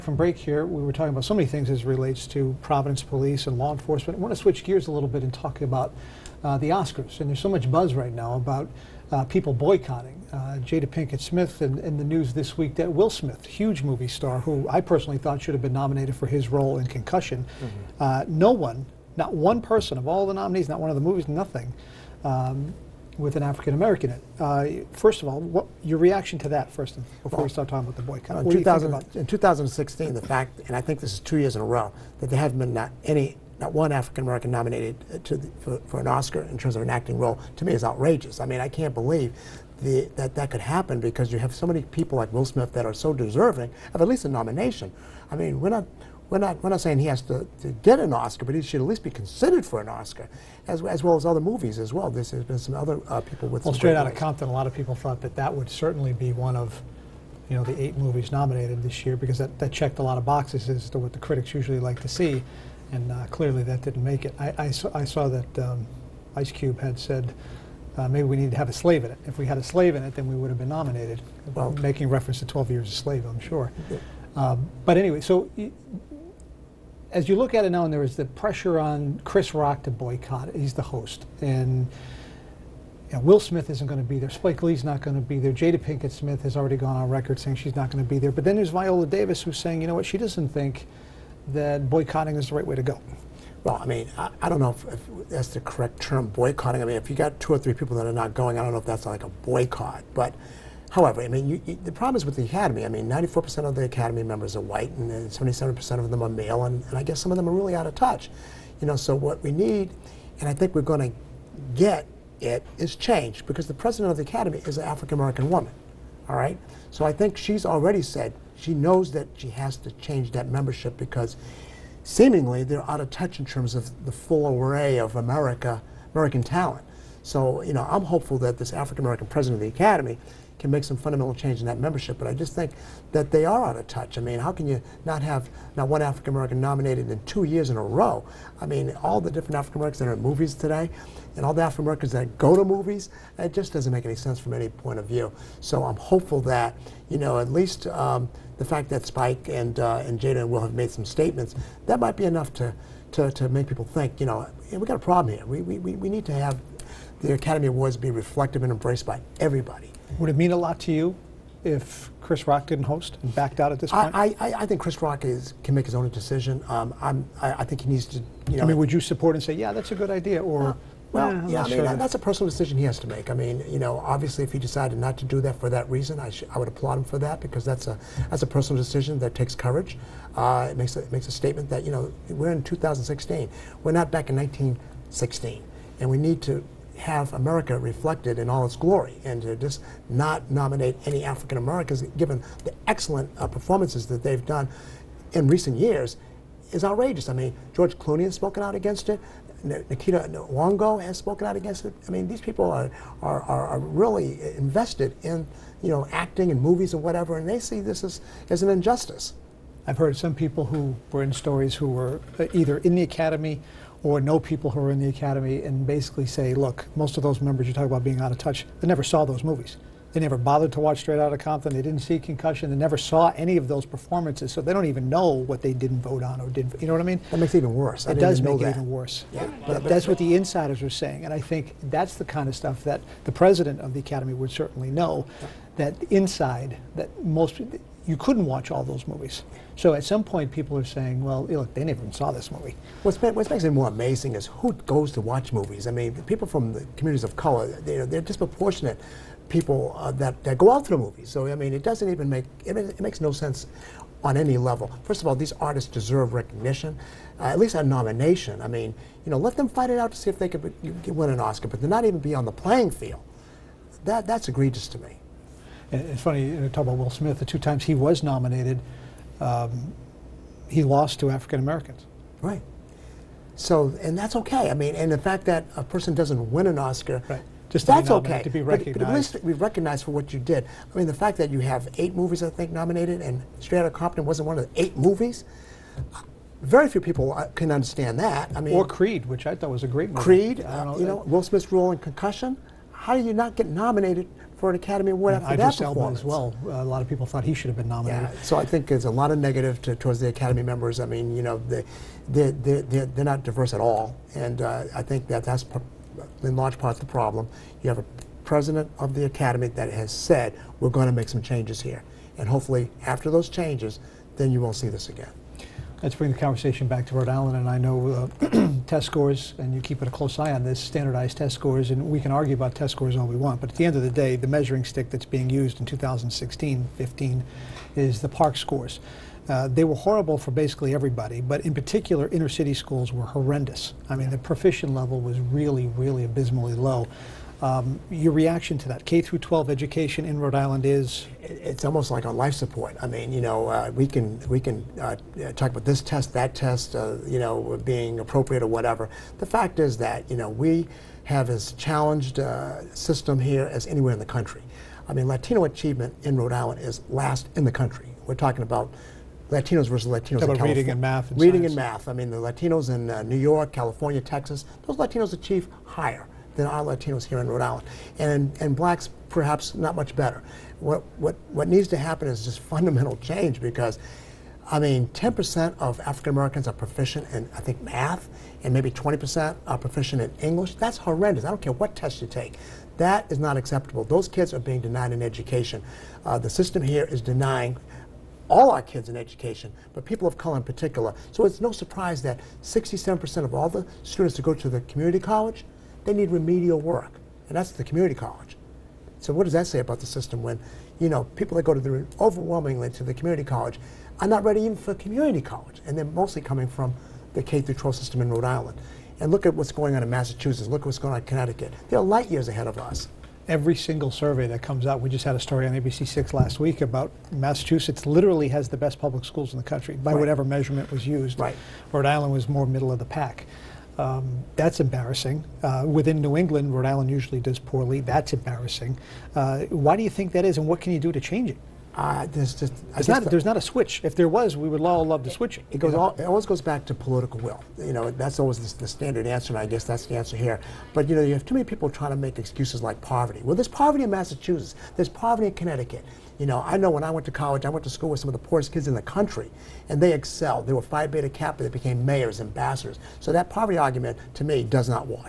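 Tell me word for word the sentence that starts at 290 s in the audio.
Creed, uh, know, you uh, know, Will Smith's role in Concussion.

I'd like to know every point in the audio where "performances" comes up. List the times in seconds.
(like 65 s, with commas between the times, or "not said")
193 s, 223 s, 295 s.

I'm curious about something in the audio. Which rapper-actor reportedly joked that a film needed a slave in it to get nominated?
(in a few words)
Ice Cube.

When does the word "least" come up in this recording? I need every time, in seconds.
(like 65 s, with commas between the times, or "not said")
44 s, 48 s, 147 s, 257 s, 279 s.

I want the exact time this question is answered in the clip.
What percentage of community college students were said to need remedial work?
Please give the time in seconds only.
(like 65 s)
392 s.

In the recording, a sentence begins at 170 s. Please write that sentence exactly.
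Or, uh, well, yeah, I mean, sure that, that's a personal decision he has to make.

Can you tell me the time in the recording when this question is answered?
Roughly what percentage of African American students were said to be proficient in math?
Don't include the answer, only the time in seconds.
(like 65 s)
375 s.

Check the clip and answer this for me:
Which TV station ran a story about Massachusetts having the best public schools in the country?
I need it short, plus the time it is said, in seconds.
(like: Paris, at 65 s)
ABC6, at 415 s.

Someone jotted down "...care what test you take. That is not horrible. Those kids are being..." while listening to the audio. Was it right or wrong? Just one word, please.
wrong.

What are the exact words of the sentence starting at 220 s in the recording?
They never bothered to watch Straight Out of Compton.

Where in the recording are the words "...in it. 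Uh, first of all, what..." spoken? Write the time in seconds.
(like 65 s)
24 s.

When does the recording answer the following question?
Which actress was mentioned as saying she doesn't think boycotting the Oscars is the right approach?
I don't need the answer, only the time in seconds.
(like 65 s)
88 s.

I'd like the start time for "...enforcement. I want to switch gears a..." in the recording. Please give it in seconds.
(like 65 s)
3 s.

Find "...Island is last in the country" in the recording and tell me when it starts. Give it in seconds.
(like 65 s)
356 s.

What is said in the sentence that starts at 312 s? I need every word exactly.
And hopefully, after those changes, then you won't see this again.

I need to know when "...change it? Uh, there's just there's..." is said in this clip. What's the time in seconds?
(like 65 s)
431 s.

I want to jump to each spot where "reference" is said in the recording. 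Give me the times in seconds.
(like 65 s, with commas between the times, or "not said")
72 s.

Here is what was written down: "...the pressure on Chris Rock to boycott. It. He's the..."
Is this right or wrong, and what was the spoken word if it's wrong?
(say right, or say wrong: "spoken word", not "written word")
right.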